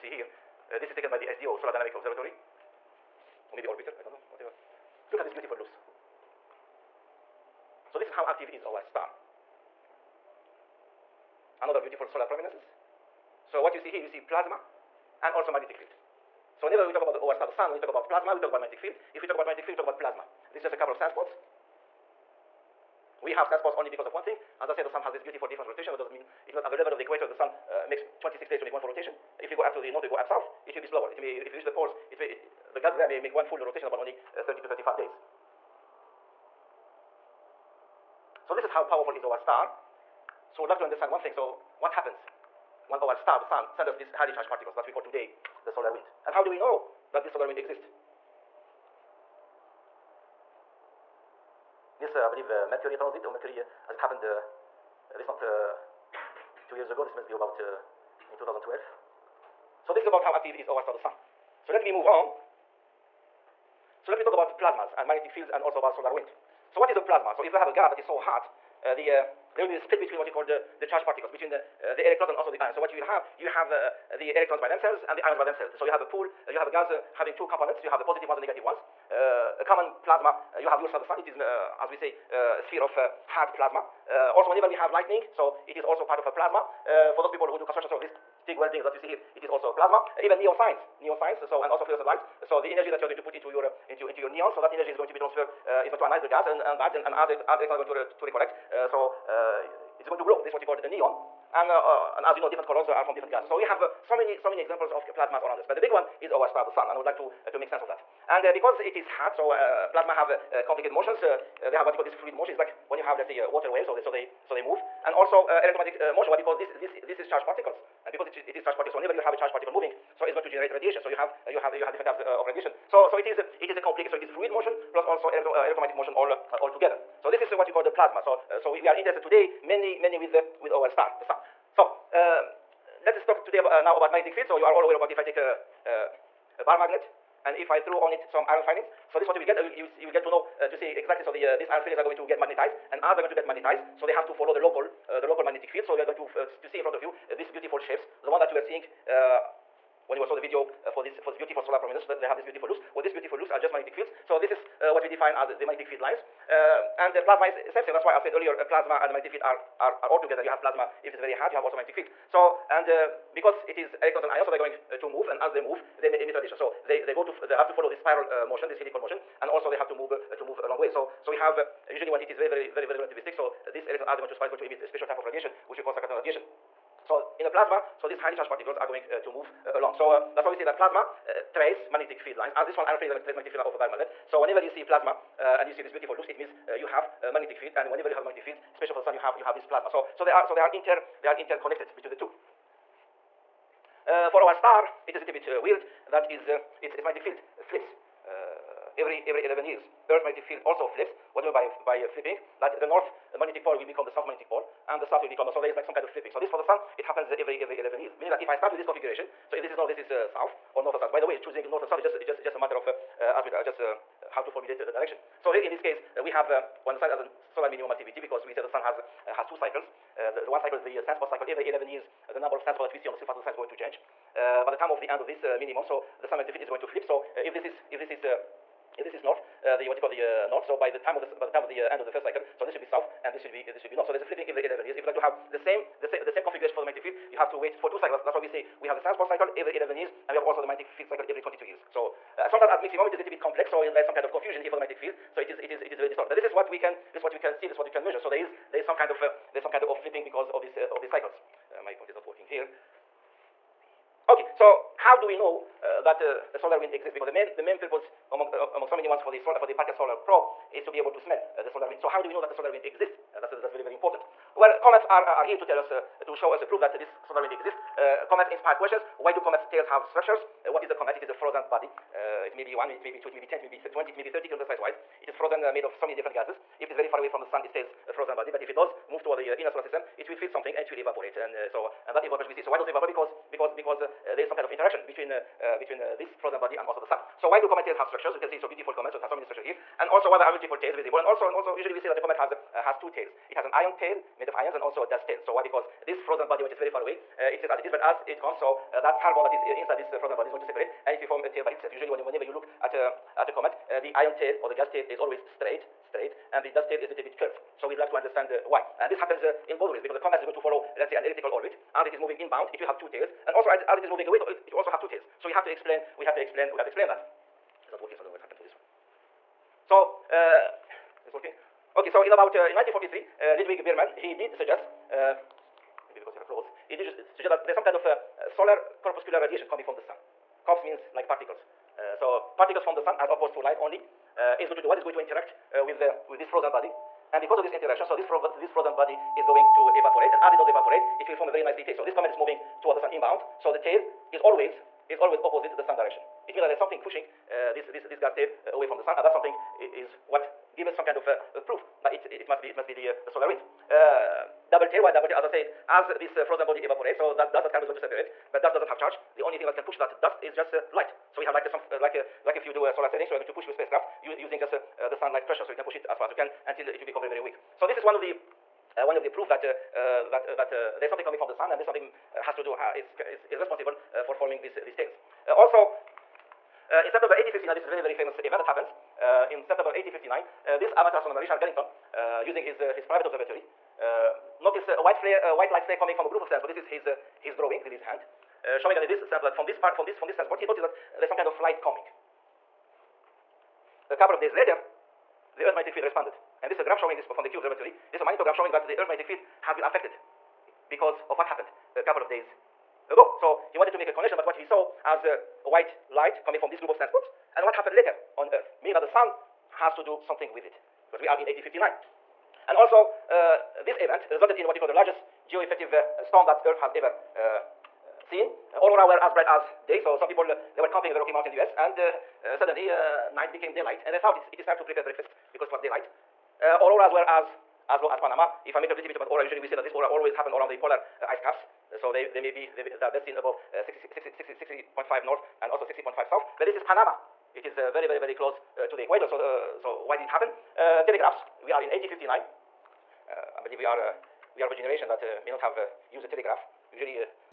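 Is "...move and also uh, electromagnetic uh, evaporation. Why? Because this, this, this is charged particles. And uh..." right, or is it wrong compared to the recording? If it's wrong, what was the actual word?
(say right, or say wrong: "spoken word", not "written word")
wrong: "motion", not "evaporation".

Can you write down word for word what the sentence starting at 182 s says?
As this one, iron filings are going to trace magnetic field of a baromagnet.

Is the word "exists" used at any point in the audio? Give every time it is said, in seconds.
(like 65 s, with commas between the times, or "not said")
47 s, 256 s, 262 s, 267 s.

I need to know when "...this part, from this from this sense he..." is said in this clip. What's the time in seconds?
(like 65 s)
389 s.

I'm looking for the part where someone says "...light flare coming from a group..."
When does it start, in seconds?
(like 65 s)
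385 s.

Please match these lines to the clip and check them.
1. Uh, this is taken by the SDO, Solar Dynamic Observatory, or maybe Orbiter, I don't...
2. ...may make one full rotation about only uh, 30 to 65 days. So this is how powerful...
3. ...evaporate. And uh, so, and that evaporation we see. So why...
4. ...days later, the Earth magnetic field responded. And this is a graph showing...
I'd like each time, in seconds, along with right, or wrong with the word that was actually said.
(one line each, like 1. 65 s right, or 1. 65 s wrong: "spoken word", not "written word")
1. 0 s right
2. 33 s wrong: "35", not "65"
3. 280 s right
4. 394 s right.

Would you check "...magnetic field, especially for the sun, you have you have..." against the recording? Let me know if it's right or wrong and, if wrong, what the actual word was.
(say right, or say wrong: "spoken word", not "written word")
right.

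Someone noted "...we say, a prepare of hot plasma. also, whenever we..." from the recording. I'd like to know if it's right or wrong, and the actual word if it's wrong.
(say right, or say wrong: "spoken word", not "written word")
wrong: "sphere", not "prepare".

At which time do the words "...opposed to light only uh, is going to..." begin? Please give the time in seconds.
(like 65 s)
333 s.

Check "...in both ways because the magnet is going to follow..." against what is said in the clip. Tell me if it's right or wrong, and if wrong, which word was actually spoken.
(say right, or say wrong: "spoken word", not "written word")
wrong: "comet", not "magnet".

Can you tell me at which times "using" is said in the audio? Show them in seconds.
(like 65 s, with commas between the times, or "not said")
364 s, 382 s.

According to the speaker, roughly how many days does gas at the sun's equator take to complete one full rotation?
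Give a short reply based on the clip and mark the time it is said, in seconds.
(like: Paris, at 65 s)
26 days, at 28 s.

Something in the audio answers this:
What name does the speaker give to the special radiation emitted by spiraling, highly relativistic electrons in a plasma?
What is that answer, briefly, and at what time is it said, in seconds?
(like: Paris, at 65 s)
cyclotron radiation, at 175 s.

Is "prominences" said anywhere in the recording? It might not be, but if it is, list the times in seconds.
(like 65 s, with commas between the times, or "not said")
12 s, 151 s.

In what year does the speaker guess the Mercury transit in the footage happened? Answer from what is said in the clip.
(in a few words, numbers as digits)
2012.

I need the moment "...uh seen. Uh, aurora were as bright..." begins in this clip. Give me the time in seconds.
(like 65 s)
417 s.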